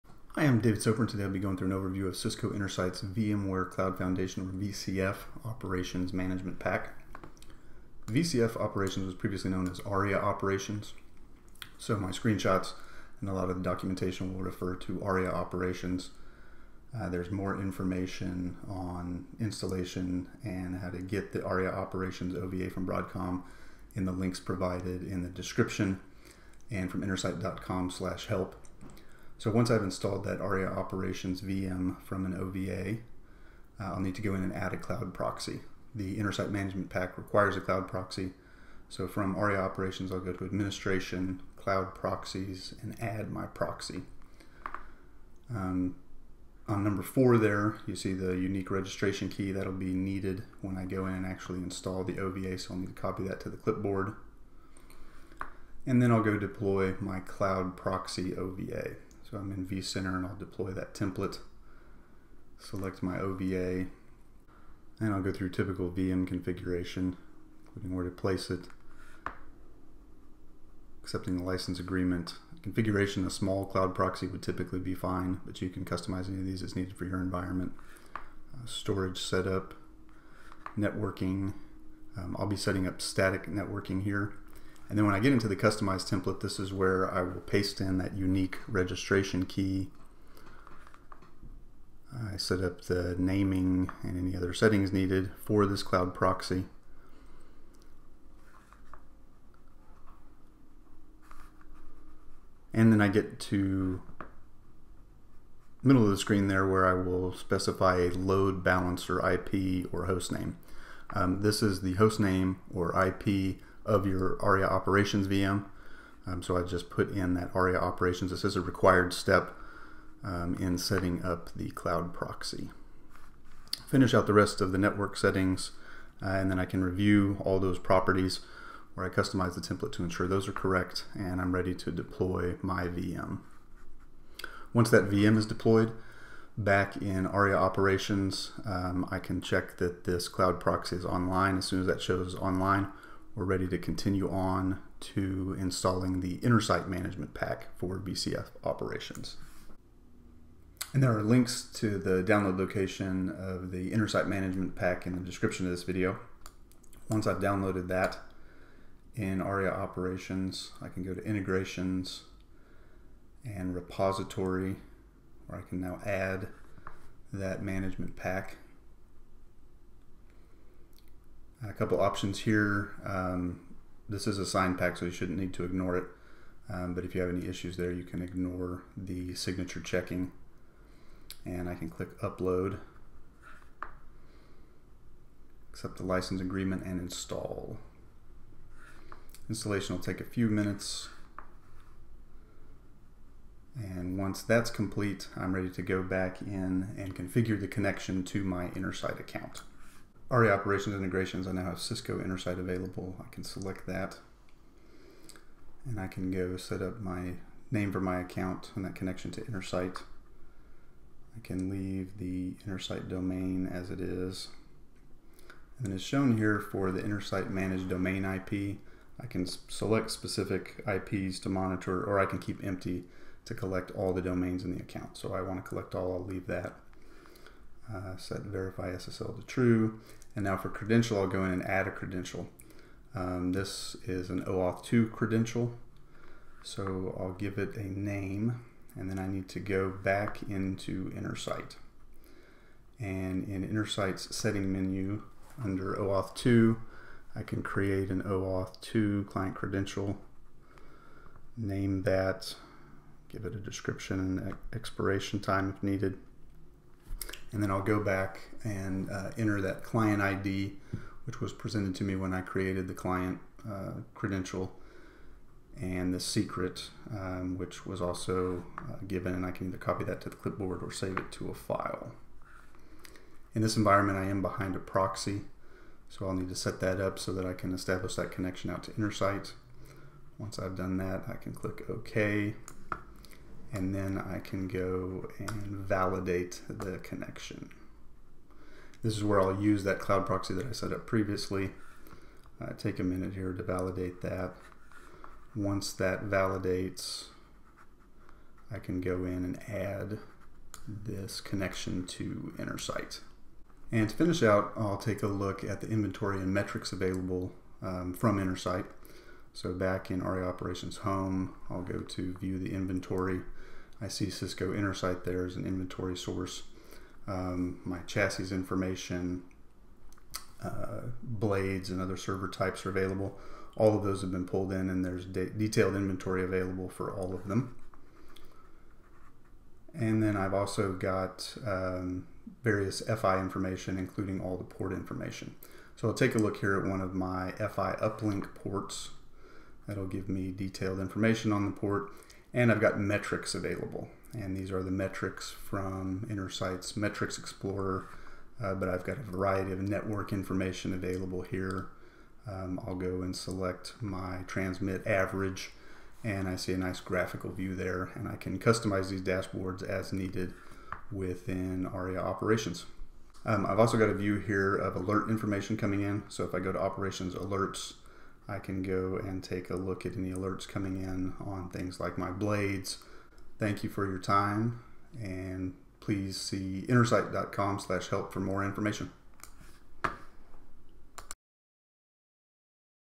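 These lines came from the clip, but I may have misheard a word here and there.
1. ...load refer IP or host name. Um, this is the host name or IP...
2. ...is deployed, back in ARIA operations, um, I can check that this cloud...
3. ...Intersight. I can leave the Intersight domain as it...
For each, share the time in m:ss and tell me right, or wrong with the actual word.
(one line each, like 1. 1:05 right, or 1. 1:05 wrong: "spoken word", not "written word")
1. 1:48 wrong: "balancer", not "refer"
2. 2:15 right
3. 3:29 right.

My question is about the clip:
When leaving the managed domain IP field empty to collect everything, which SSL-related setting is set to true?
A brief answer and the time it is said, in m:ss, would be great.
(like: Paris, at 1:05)
verify SSL, at 3:48.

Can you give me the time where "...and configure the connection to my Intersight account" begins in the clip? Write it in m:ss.
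3:16.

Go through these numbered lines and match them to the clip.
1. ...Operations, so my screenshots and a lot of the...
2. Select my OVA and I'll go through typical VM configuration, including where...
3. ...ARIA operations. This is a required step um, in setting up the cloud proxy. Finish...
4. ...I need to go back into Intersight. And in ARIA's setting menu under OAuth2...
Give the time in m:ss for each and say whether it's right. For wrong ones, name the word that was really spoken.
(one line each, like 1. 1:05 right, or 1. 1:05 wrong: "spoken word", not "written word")
1. 0:10 right
2. 1:02 right
3. 1:57 right
4. 3:59 wrong: "Intersight", not "ARIA".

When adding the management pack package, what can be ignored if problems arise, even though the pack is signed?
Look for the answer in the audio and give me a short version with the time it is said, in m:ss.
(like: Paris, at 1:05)
signature checking, at 2:59.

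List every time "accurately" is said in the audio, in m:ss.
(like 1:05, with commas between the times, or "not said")
not said.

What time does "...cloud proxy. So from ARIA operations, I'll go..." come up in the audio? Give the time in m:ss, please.
0:37.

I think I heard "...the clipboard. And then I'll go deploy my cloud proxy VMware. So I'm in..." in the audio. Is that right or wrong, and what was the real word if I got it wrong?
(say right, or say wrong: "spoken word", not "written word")
wrong: "OVA", not "VMware".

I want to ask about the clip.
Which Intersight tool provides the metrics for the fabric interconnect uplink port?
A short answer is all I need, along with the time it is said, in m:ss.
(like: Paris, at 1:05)
Metrics Explorer, at 5:46.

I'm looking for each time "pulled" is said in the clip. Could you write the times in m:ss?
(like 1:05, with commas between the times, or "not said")
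5:24.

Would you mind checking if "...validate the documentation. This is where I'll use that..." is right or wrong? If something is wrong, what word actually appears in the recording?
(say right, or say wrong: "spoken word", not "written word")
wrong: "connection", not "documentation".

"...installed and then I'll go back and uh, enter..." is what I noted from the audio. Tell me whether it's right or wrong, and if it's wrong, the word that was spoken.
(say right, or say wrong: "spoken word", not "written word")
wrong: "needed", not "installed".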